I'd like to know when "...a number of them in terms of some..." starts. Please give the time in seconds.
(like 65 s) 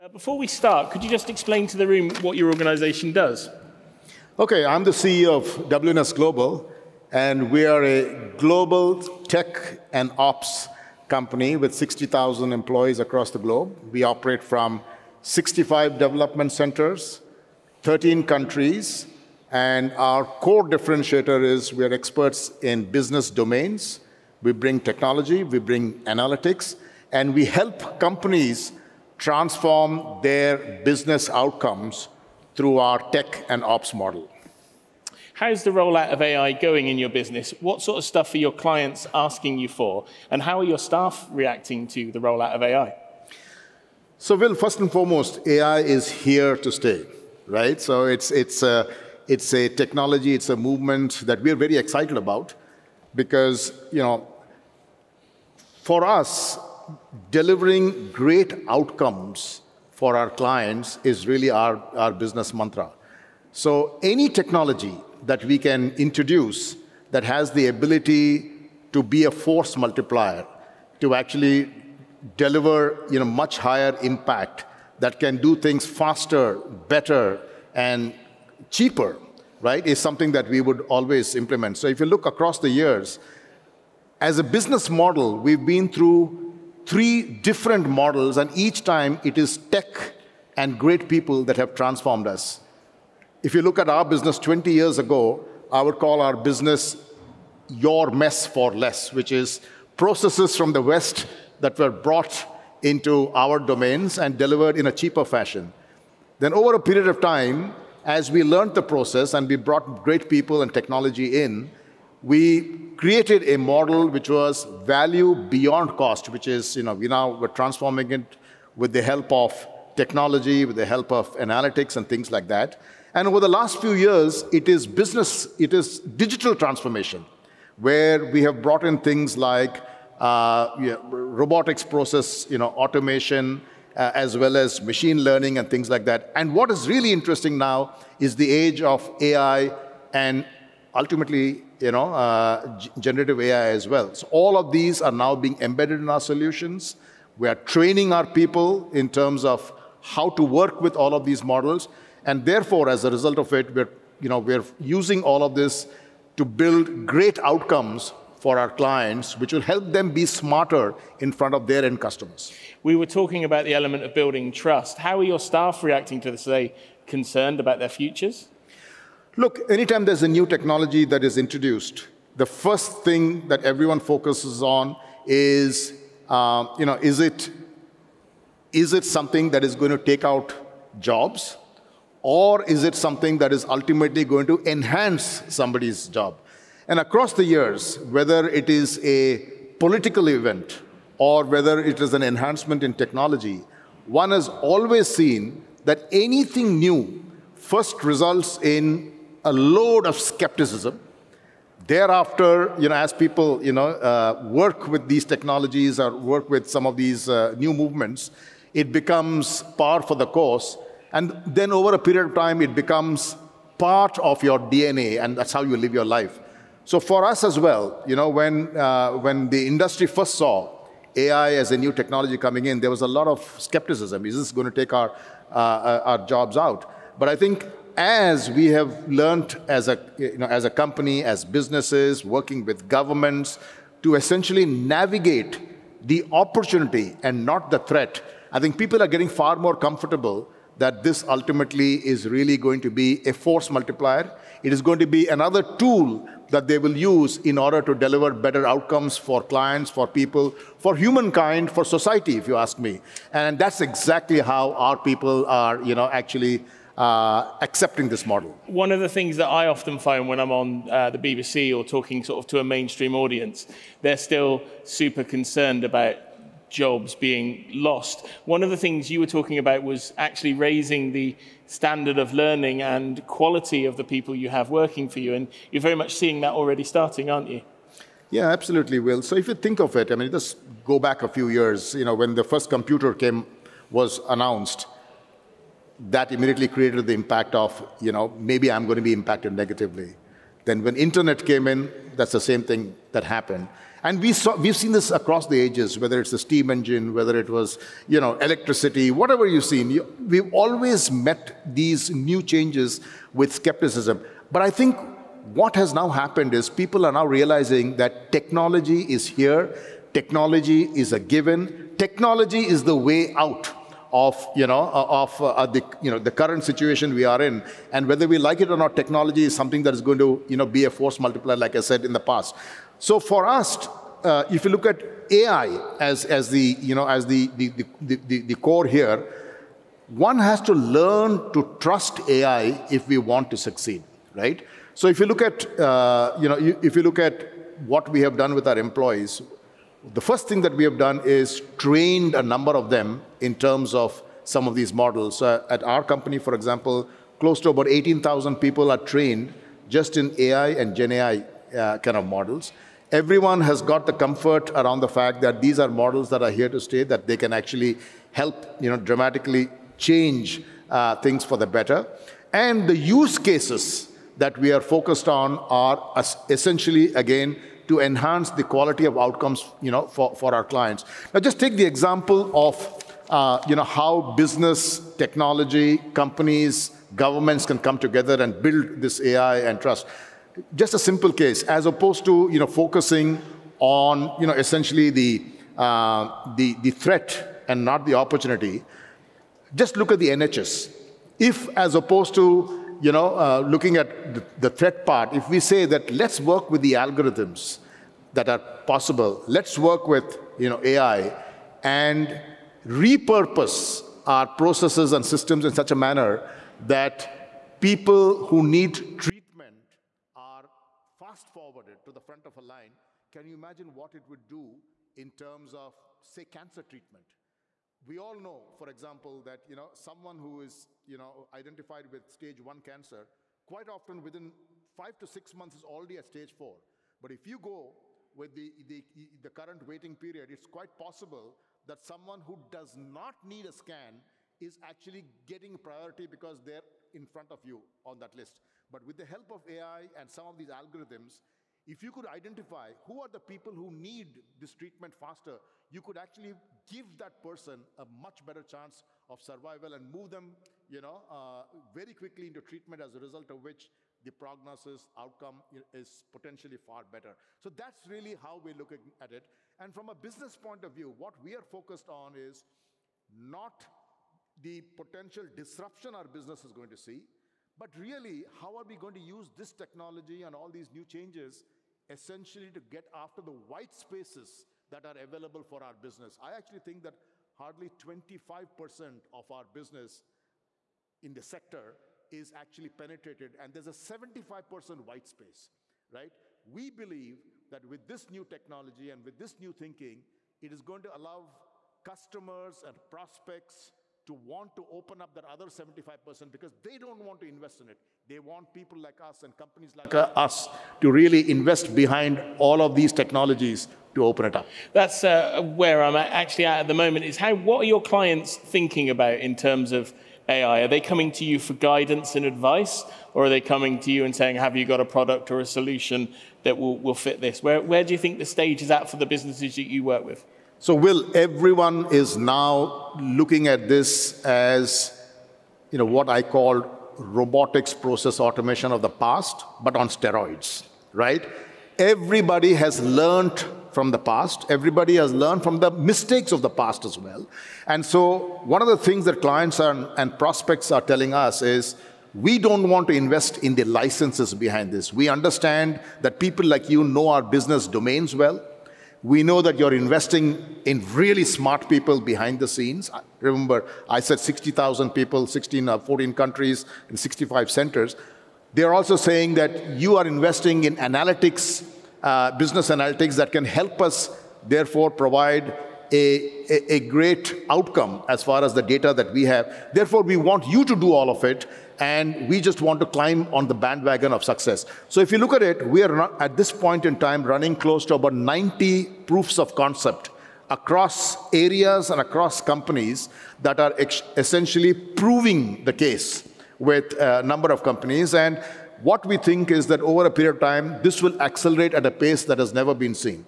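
342 s.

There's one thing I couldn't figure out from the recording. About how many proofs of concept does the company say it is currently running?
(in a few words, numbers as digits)
90.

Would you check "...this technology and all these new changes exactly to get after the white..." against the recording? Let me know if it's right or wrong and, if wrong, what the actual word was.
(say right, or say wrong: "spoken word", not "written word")
wrong: "essentially", not "exactly".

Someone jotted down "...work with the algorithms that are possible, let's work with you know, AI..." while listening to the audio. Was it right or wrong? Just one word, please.
right.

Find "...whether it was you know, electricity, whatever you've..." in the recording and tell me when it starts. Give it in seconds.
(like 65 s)
297 s.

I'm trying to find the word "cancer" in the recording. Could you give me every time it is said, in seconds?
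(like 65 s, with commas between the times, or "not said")
416 s, 422 s.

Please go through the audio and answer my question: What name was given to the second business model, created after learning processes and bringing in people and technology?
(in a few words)
value beyond cost.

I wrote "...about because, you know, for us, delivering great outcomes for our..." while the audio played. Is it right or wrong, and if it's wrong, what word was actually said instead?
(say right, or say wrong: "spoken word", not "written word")
right.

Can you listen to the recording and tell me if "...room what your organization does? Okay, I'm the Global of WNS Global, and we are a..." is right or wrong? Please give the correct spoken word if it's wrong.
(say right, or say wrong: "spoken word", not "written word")
wrong: "CEO", not "Global".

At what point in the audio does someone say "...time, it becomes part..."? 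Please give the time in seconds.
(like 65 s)
212 s.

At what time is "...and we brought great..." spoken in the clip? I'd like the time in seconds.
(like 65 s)
109 s.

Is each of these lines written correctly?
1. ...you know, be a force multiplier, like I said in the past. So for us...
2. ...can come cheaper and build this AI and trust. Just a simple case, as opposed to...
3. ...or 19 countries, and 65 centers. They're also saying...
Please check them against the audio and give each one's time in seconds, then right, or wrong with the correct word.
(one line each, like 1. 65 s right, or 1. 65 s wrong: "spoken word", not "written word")
1. 320 s right
2. 377 s wrong: "together", not "cheaper"
3. 555 s wrong: "14", not "19".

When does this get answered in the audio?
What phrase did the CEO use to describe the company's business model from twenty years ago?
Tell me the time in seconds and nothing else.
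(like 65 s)
97 s.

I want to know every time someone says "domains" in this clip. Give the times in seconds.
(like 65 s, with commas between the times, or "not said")
23 s, 103 s, 547 s.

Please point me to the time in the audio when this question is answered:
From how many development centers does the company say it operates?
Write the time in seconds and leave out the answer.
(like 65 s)
15 s.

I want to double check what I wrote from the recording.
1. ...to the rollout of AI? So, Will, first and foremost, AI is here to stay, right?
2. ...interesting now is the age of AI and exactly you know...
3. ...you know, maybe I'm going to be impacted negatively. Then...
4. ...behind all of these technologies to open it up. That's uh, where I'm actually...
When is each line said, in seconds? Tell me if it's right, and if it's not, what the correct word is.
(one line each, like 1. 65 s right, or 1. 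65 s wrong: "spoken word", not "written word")
1. 41 s right
2. 137 s wrong: "ultimately", not "exactly"
3. 288 s right
4. 501 s right.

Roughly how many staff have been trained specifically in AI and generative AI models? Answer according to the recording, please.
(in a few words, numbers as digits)
18,000.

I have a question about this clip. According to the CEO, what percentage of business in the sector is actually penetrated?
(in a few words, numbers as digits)
25%.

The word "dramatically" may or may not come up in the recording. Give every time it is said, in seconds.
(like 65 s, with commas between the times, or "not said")
358 s.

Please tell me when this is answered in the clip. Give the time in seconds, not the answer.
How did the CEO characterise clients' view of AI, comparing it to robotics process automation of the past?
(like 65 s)
529 s.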